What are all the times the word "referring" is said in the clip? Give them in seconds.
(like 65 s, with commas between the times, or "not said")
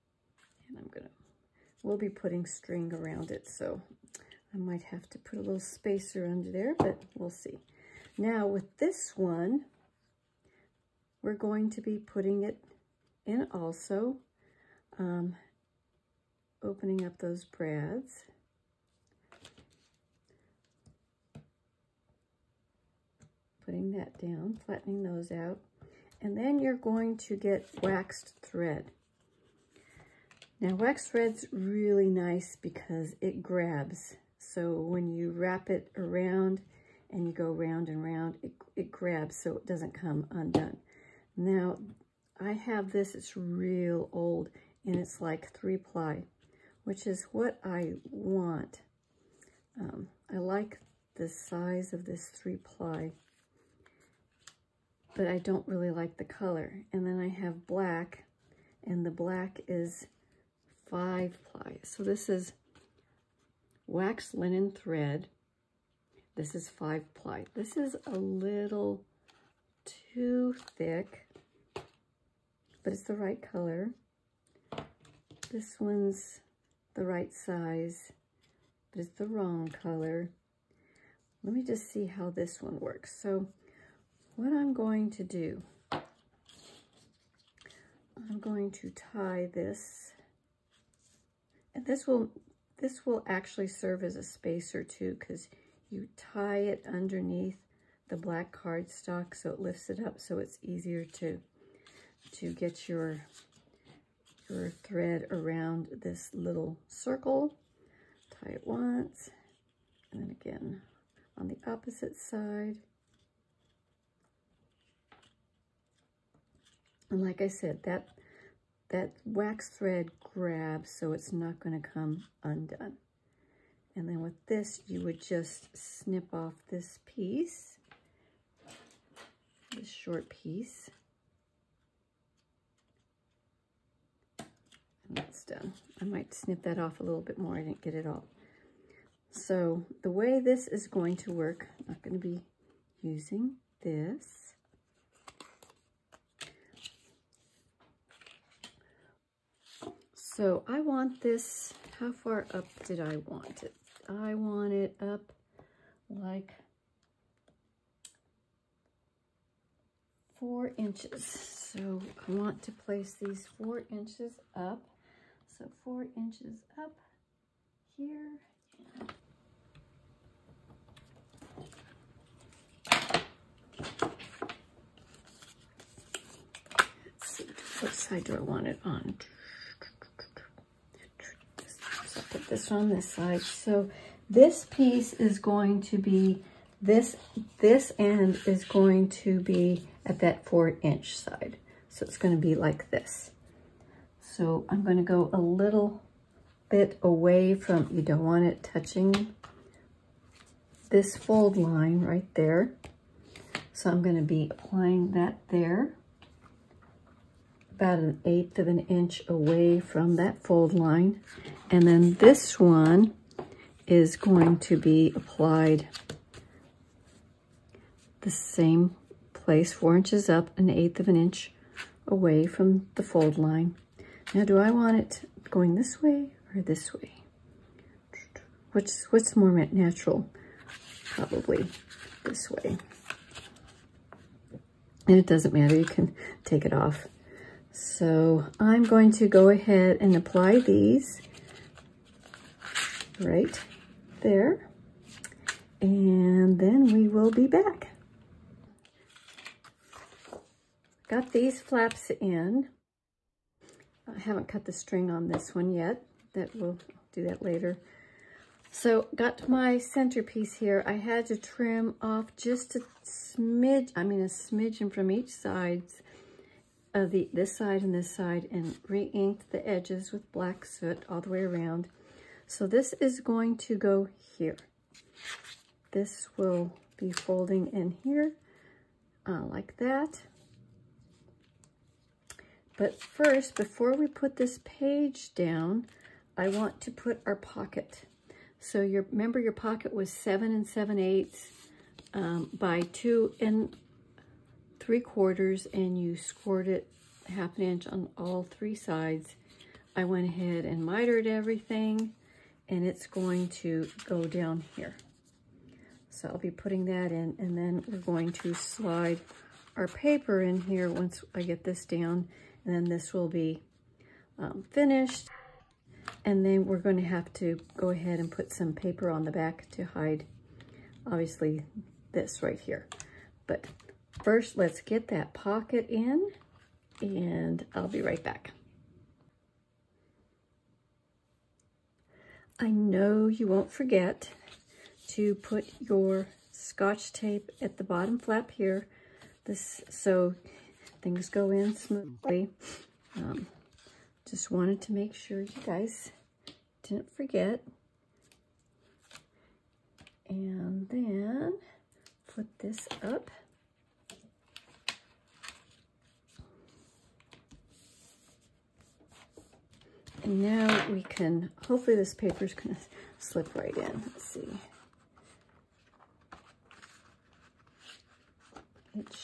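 not said.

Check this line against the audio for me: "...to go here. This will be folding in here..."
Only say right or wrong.
right.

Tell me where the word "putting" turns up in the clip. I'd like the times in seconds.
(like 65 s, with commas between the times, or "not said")
2 s, 11 s, 23 s, 306 s.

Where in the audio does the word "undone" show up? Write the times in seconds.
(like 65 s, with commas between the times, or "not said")
40 s, 122 s.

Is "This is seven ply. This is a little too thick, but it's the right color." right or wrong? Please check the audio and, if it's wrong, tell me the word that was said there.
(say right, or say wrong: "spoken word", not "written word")
wrong: "five", not "seven".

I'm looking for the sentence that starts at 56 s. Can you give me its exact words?
And then I have black, and the black is five ply.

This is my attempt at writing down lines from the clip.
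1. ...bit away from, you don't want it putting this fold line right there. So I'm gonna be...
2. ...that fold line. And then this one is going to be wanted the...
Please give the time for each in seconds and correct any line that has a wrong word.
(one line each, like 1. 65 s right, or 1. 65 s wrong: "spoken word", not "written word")
1. 196 s wrong: "touching", not "putting"
2. 210 s wrong: "applied", not "wanted".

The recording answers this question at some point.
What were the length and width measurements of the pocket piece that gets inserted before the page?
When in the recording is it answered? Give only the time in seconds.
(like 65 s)
290 s.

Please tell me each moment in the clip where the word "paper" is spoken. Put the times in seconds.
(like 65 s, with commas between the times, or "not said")
309 s, 318 s, 362 s.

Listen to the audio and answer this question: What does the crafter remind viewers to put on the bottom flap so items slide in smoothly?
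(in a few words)
scotch tape.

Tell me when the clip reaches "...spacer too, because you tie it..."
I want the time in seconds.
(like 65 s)
94 s.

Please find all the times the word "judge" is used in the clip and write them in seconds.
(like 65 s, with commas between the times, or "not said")
not said.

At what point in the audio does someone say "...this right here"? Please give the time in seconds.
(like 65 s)
322 s.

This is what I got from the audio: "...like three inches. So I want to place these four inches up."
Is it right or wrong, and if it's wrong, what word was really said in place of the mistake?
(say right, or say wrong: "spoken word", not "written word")
wrong: "four", not "three".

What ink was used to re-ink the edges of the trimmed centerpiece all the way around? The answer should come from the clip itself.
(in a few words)
black soot.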